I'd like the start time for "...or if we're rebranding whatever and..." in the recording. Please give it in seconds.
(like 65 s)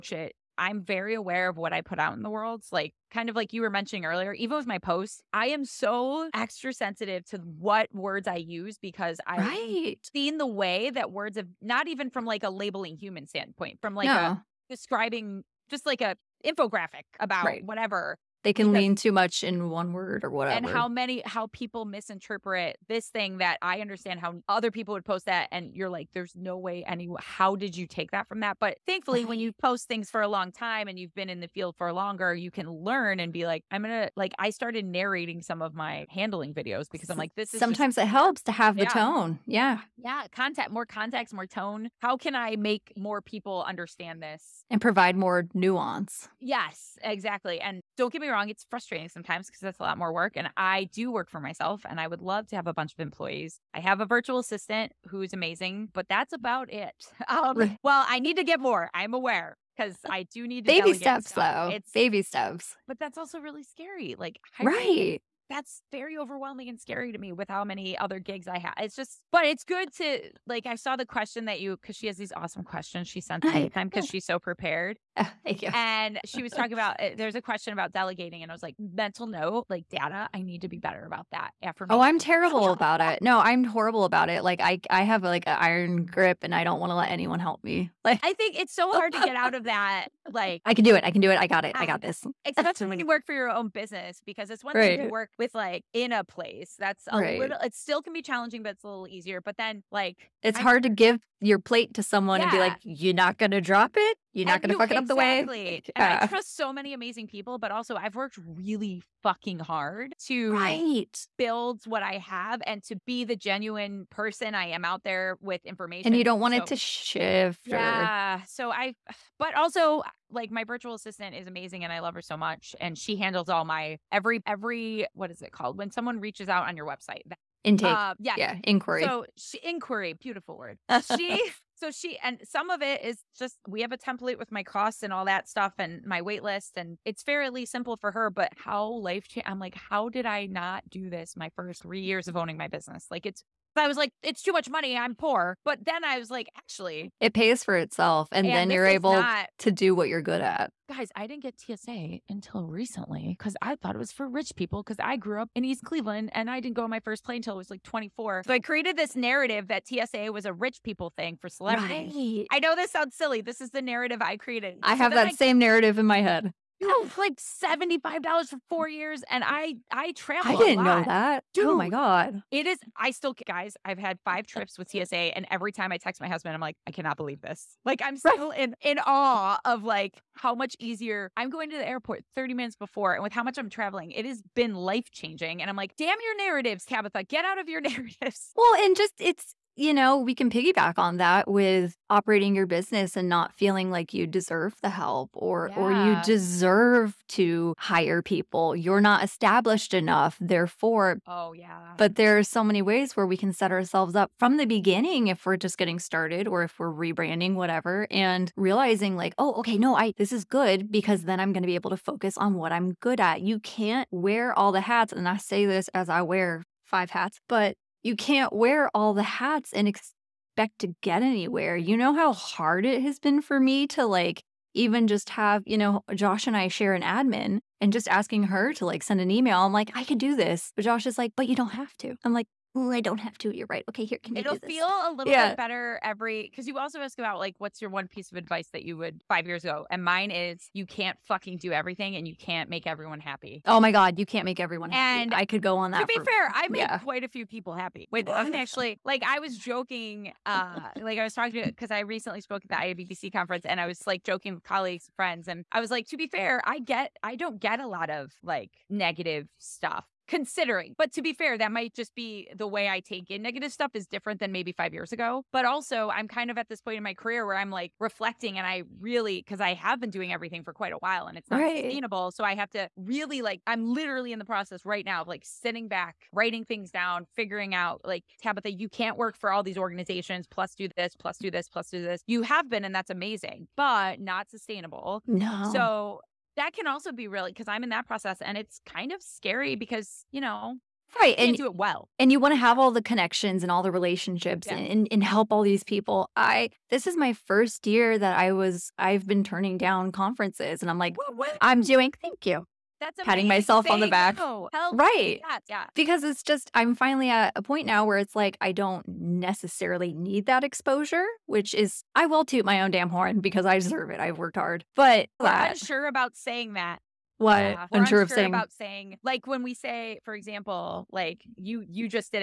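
206 s.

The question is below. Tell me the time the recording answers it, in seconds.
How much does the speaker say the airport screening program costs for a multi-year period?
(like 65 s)
167 s.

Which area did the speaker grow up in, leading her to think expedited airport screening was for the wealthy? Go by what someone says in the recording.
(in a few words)
East Cleveland.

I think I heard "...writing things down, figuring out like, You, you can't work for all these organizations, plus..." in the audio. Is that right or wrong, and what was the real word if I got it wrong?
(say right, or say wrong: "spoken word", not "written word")
wrong: "Tabitha", not "You".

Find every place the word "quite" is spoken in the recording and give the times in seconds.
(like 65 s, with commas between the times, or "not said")
246 s, 270 s.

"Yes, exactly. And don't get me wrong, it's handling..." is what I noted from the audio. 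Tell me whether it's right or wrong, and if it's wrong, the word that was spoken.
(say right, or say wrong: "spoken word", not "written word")
wrong: "frustrating", not "handling".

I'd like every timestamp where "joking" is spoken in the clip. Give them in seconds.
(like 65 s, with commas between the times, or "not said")
249 s, 254 s.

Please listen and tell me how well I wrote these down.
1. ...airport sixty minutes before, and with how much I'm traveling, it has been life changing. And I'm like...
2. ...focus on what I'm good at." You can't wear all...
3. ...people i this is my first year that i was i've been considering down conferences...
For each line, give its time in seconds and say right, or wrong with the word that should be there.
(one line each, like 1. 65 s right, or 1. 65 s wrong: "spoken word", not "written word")
1. 181 s wrong: "thirty", not "sixty"
2. 211 s right
3. 295 s wrong: "turning", not "considering".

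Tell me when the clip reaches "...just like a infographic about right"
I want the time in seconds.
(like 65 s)
15 s.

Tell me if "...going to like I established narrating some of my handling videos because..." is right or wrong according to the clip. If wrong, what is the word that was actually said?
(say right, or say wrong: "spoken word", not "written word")
wrong: "started", not "established".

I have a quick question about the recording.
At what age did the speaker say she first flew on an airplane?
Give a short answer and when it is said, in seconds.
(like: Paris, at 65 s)
24, at 157 s.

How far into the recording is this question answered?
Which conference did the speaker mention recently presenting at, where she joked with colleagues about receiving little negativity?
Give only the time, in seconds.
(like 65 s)
252 s.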